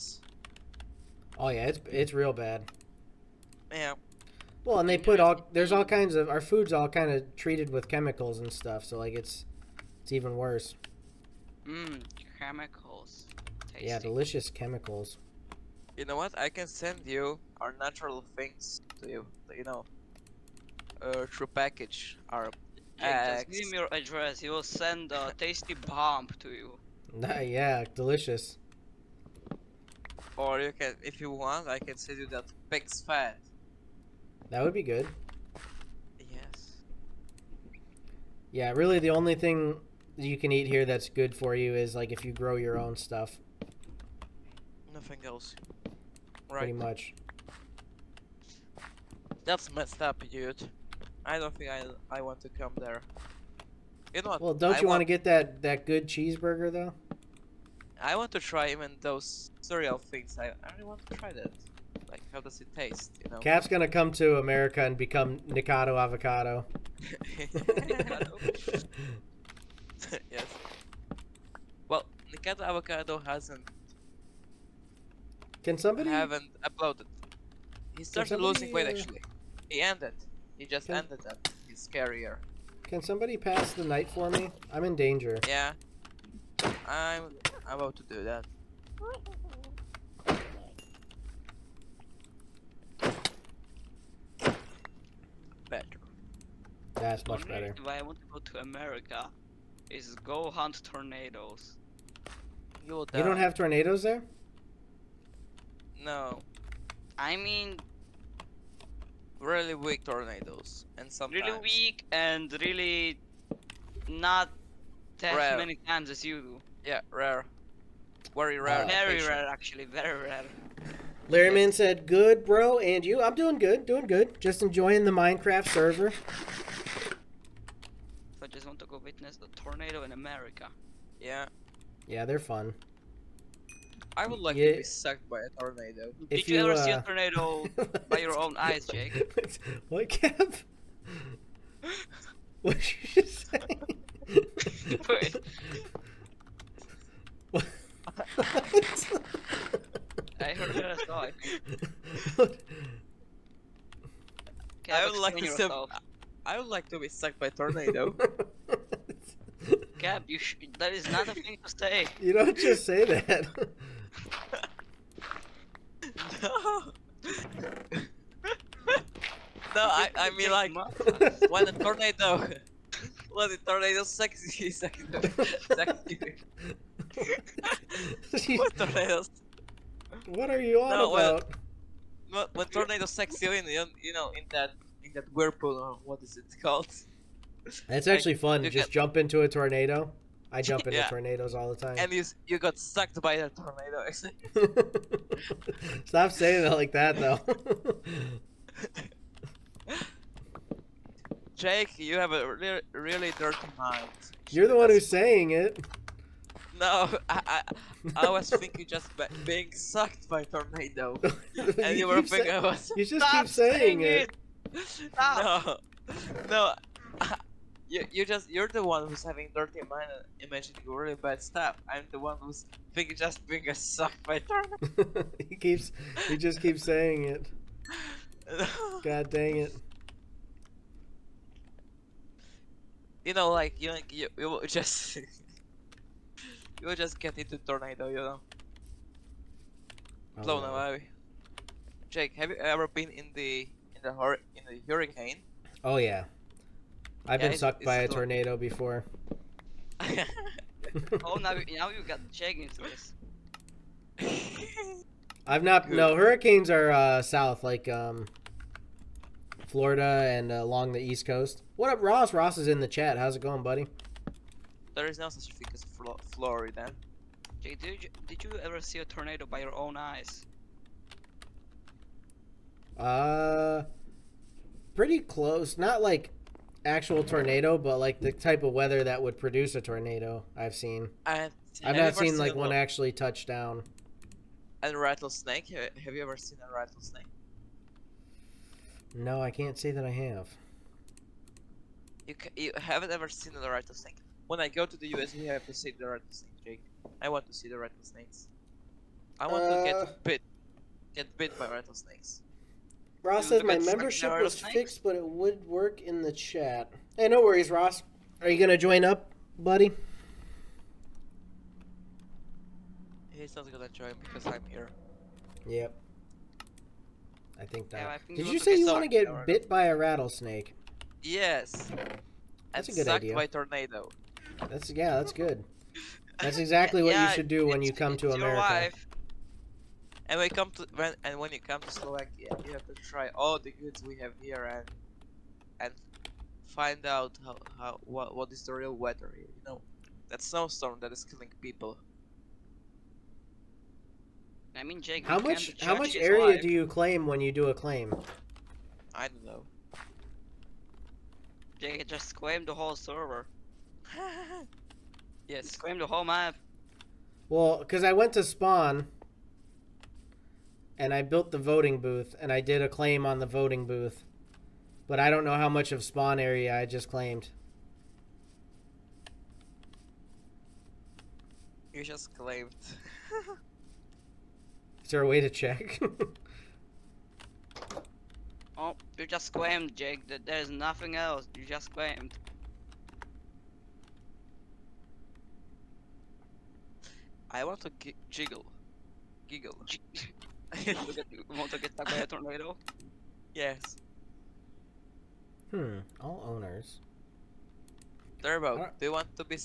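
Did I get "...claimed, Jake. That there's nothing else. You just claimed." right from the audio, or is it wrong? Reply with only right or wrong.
right.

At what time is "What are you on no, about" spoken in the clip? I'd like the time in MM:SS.
03:00.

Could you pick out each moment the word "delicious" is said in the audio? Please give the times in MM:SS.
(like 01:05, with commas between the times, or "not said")
00:13, 00:27.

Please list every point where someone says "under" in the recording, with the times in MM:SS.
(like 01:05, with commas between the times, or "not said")
not said.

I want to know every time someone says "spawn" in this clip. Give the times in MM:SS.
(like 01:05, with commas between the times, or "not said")
05:58, 06:06.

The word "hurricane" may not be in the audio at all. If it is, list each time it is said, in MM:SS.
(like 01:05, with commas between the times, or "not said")
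04:04, 04:16.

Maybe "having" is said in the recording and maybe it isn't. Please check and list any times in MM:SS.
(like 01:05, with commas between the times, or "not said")
03:39.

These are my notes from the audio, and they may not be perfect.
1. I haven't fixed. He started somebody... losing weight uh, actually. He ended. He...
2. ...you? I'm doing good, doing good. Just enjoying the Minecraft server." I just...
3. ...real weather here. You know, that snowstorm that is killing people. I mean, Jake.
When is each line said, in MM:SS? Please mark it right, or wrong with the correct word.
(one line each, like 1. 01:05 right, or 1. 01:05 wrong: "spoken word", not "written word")
1. 01:16 wrong: "uploaded", not "fixed"
2. 02:03 right
3. 05:38 right.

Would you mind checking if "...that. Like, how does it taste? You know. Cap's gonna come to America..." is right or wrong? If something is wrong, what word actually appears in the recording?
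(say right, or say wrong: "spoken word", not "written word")
right.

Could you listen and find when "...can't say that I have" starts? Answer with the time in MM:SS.
04:49.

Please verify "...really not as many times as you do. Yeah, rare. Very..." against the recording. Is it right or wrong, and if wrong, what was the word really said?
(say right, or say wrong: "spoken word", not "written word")
right.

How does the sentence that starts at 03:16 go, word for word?
Stop saying it like that, though.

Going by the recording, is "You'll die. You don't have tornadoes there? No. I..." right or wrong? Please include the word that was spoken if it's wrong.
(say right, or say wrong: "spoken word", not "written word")
right.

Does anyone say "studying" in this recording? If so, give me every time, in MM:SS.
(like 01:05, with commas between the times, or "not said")
not said.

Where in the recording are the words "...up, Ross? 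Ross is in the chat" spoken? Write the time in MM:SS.
04:21.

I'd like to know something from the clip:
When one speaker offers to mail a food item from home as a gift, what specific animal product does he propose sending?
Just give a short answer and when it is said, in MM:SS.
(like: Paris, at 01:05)
pig's fat, at 00:32.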